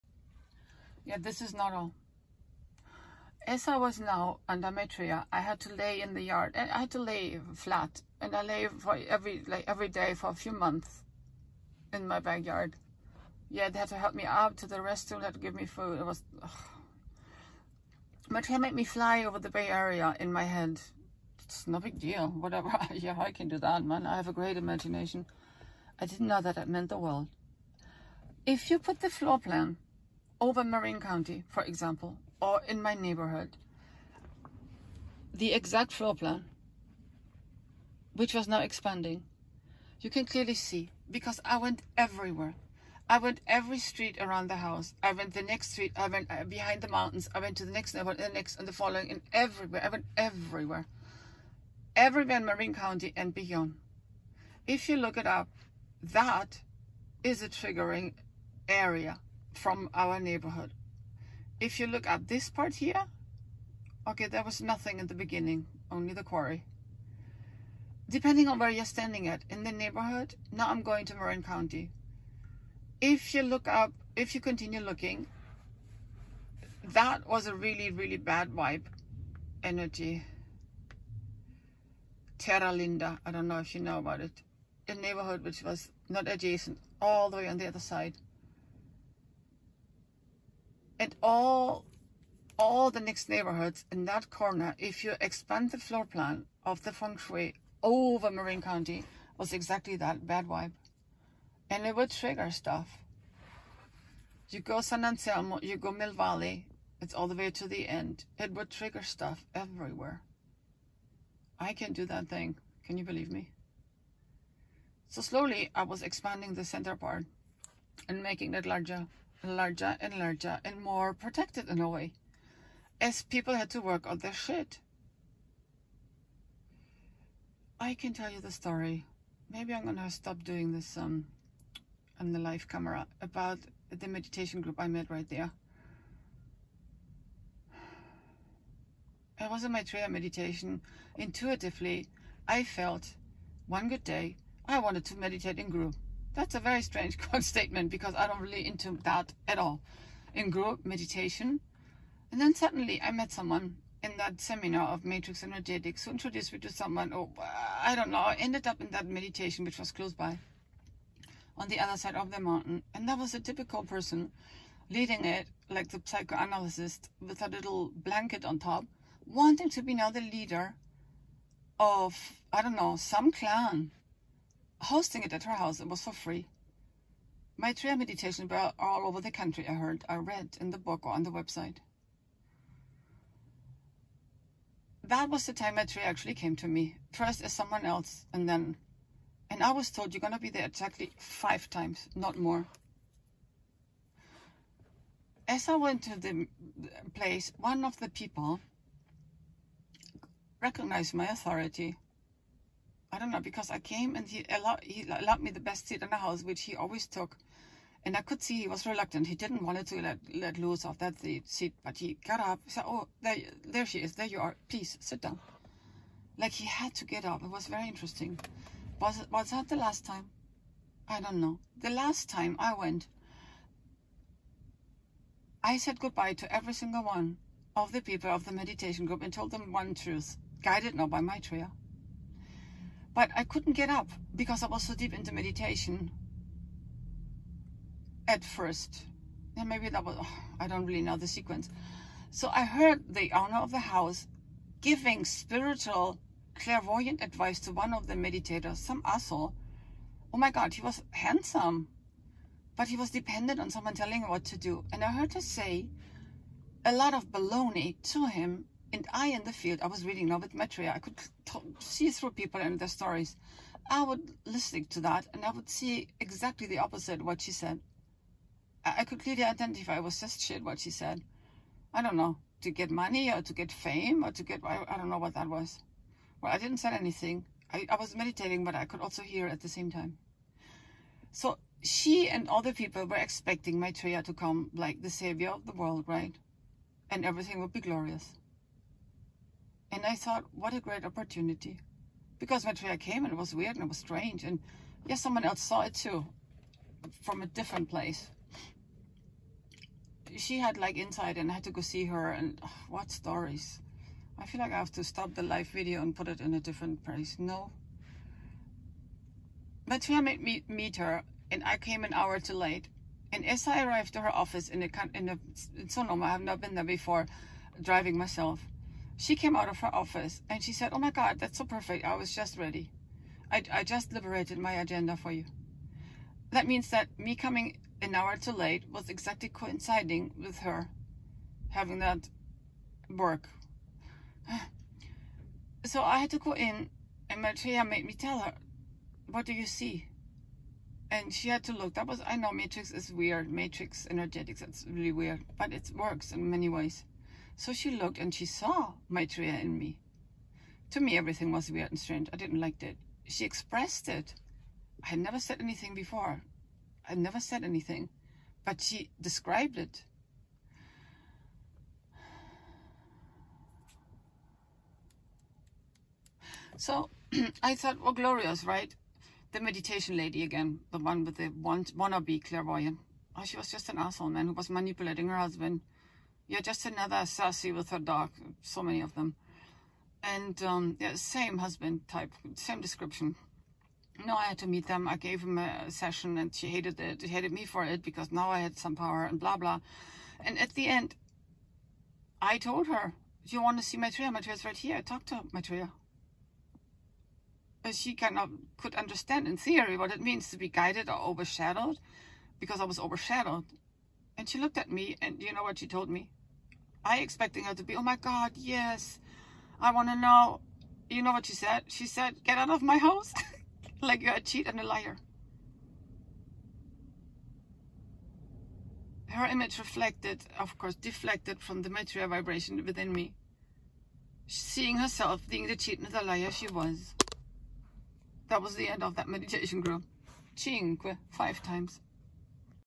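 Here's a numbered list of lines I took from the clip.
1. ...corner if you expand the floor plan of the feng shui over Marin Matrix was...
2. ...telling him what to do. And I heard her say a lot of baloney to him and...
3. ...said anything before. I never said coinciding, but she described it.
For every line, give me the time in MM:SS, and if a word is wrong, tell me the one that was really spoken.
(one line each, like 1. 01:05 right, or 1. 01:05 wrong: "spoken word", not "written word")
1. 01:34 wrong: "County", not "Matrix"
2. 04:13 right
3. 05:55 wrong: "anything", not "coinciding".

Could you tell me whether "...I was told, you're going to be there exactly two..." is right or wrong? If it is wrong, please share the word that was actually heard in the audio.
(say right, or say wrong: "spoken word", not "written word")
wrong: "five", not "two".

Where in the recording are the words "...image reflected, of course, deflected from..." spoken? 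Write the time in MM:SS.
06:59.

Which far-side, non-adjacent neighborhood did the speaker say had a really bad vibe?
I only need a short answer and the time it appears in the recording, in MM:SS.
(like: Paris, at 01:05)
Terra Linda, at 01:22.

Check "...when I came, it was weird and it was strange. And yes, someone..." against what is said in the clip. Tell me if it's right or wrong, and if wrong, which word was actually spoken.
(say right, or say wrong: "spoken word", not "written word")
right.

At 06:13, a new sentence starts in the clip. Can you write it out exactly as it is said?
Oh, she was just an asshole man who was manipulating her husband you're just another sassy with her dog.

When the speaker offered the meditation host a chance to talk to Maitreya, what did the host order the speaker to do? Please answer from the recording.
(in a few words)
Get out of my house.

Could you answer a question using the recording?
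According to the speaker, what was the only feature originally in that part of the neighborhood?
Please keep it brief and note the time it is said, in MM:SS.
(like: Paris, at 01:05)
The quarry, at 01:05.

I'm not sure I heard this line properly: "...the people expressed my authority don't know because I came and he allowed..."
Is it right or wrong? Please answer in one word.
wrong.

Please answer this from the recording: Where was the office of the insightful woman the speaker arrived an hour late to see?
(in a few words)
Sonoma.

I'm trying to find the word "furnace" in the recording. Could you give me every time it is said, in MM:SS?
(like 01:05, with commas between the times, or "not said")
not said.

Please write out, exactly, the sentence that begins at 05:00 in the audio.
She had like insight and I had to go see her and oh, what stories.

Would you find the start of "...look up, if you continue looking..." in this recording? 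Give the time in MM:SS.
01:13.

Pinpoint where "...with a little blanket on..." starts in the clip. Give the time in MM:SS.
02:47.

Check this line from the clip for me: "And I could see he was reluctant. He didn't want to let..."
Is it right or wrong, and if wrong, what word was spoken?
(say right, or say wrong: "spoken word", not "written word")
right.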